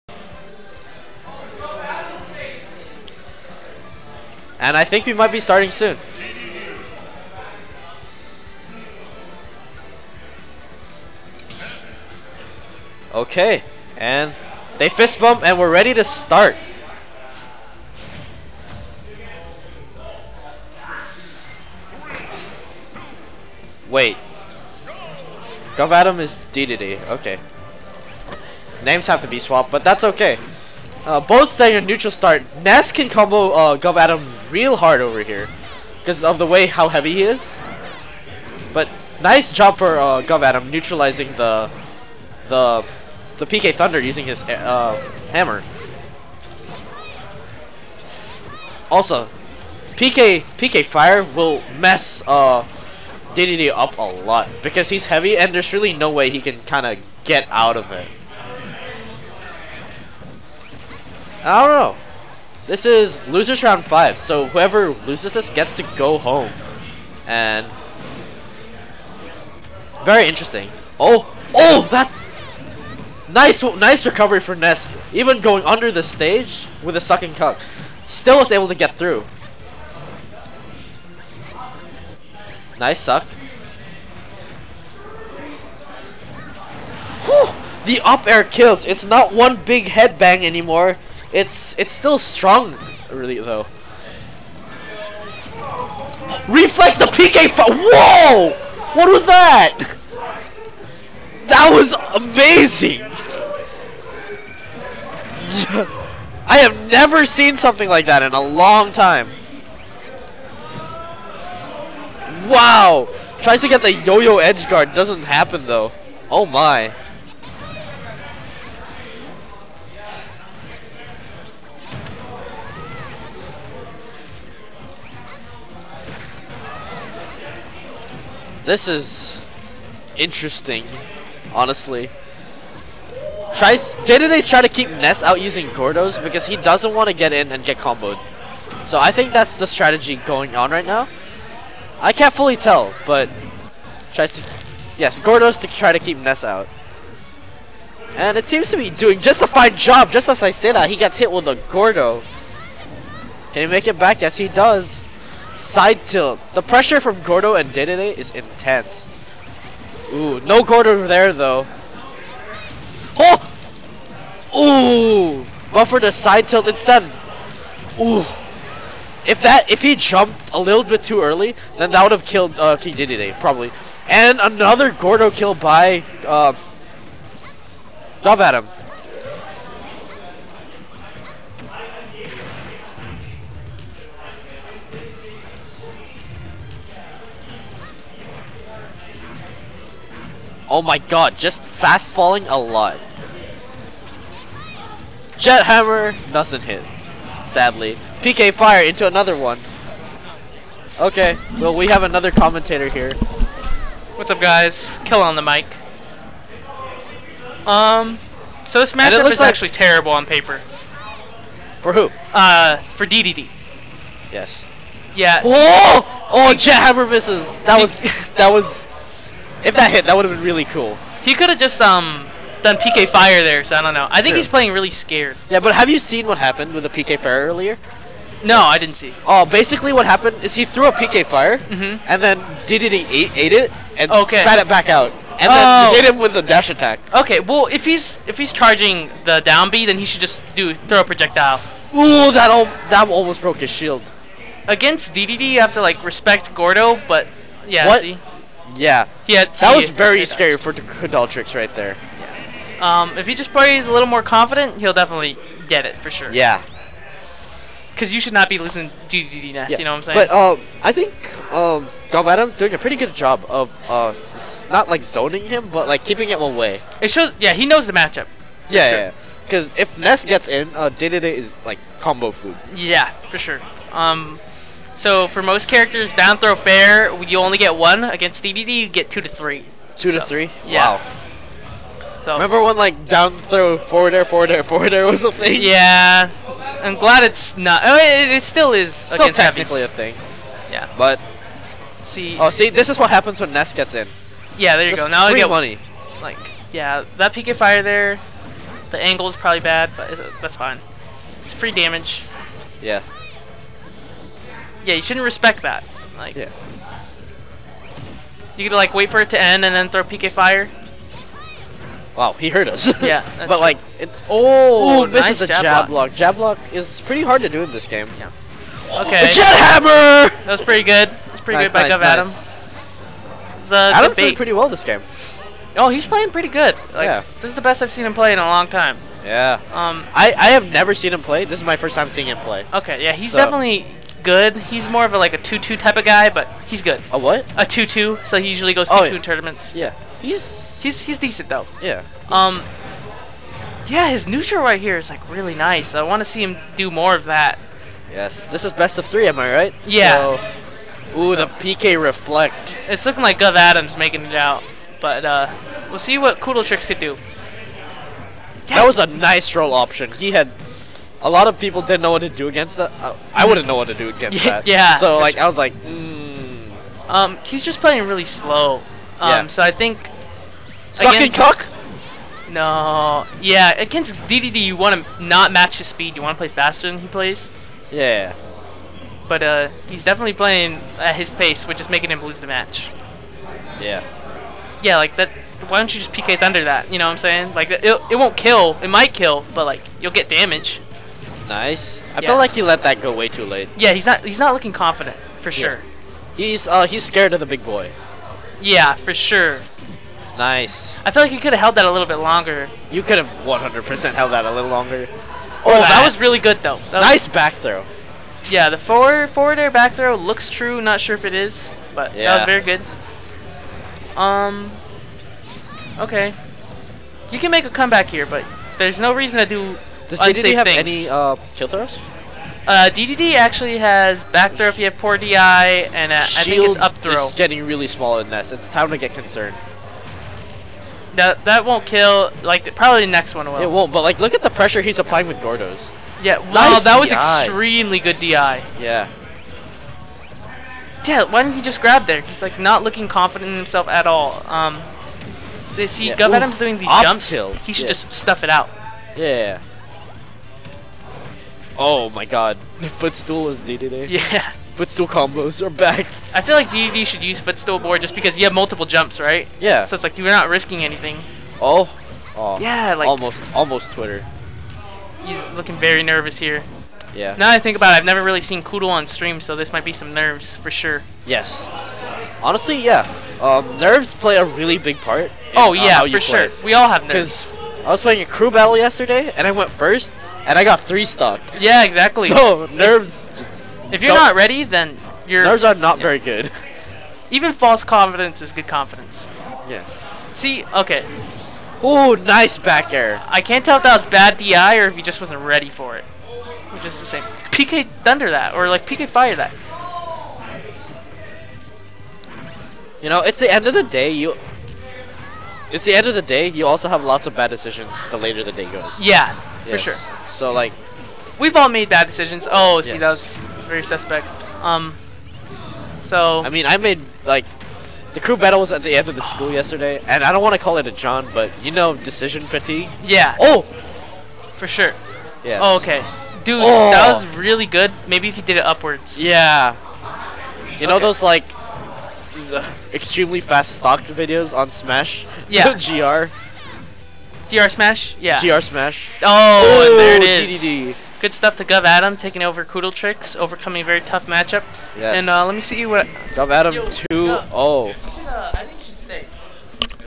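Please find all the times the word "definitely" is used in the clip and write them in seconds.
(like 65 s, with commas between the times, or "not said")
254 s, 333 s, 380 s.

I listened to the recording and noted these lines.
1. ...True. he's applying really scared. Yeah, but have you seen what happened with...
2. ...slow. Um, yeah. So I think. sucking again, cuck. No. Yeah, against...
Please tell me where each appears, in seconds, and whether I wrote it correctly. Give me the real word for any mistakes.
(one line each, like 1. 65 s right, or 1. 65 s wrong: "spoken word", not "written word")
1. 224 s wrong: "playing", not "applying"
2. 368 s right.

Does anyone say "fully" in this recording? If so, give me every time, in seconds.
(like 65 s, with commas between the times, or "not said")
142 s.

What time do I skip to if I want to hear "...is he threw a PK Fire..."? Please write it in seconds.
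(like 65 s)
230 s.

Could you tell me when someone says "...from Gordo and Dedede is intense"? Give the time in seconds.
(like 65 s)
156 s.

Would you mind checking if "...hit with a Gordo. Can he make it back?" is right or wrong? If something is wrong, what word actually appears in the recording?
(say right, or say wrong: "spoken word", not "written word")
right.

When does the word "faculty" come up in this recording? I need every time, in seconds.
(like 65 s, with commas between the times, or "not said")
not said.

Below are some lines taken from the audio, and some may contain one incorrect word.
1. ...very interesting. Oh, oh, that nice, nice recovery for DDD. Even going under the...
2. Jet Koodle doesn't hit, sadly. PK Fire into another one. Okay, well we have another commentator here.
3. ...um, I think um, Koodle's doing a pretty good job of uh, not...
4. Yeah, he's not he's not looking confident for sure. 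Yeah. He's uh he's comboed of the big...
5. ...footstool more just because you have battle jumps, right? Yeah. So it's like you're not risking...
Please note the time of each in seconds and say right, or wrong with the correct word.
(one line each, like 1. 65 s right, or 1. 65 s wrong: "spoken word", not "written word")
1. 70 s wrong: "Ness", not "DDD"
2. 195 s wrong: "Hammer", not "Koodle"
3. 260 s wrong: "GovAtom", not "Koodle"
4. 393 s wrong: "scared", not "comboed"
5. 457 s wrong: "multiple", not "battle".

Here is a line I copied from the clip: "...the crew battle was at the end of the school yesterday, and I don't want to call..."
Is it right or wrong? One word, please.
right.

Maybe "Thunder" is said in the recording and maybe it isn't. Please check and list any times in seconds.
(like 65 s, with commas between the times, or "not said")
43 s, 386 s, 498 s.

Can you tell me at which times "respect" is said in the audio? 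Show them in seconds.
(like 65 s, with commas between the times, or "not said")
246 s, 305 s.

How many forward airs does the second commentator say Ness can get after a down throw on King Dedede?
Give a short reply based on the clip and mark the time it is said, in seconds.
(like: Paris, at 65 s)
2 to 3, at 279 s.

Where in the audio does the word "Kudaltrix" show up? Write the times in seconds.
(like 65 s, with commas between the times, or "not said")
250 s, 356 s, 542 s.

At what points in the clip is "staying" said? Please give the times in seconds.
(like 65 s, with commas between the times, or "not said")
31 s.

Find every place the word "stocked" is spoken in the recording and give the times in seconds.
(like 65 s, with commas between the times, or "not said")
481 s, 533 s.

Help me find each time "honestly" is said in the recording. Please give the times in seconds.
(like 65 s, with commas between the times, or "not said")
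131 s, 472 s.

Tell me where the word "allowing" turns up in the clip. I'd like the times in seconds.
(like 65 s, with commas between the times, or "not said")
not said.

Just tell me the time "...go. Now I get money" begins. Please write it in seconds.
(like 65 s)
295 s.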